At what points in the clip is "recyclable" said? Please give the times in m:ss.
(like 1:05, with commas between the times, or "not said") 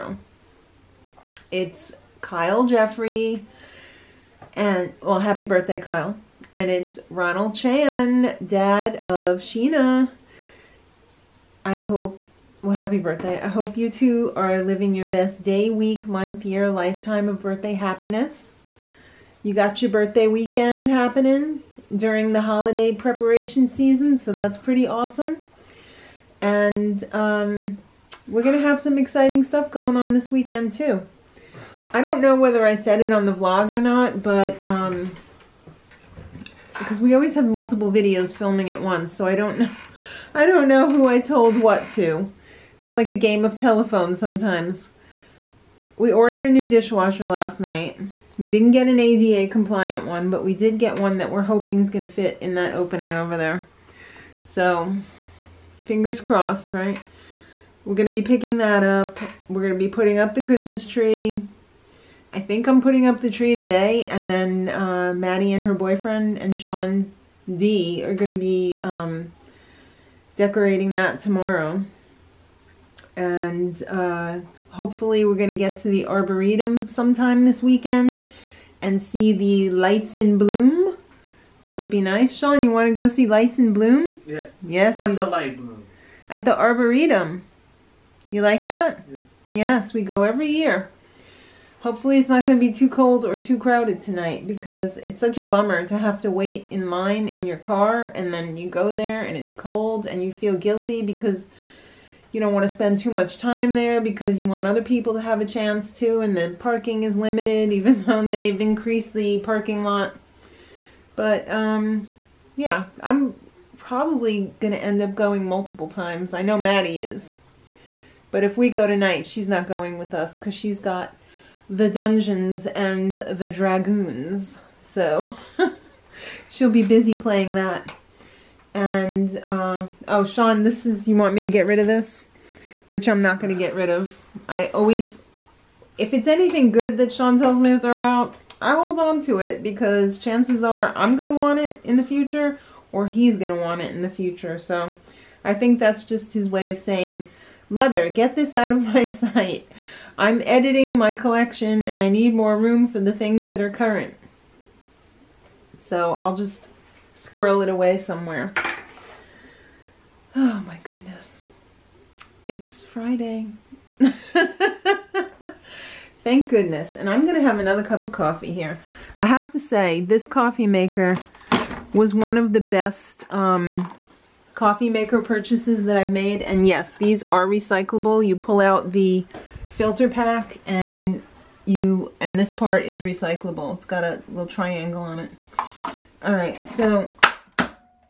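2:57, 3:02.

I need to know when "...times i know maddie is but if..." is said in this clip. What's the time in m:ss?
1:55.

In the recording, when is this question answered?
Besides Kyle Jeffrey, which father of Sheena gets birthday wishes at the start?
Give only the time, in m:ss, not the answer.
0:07.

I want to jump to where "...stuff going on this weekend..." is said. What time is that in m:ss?
0:29.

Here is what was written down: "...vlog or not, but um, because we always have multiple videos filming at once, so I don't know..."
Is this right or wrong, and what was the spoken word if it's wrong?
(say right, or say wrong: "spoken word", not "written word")
right.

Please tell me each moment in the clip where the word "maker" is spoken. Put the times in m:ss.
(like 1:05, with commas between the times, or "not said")
2:50, 2:54.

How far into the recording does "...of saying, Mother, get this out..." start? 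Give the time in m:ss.
2:26.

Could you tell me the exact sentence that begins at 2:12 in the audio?
Which I'm not going to get rid of.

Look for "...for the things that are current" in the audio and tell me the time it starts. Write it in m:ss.
2:32.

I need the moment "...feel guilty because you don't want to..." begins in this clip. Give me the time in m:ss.
1:40.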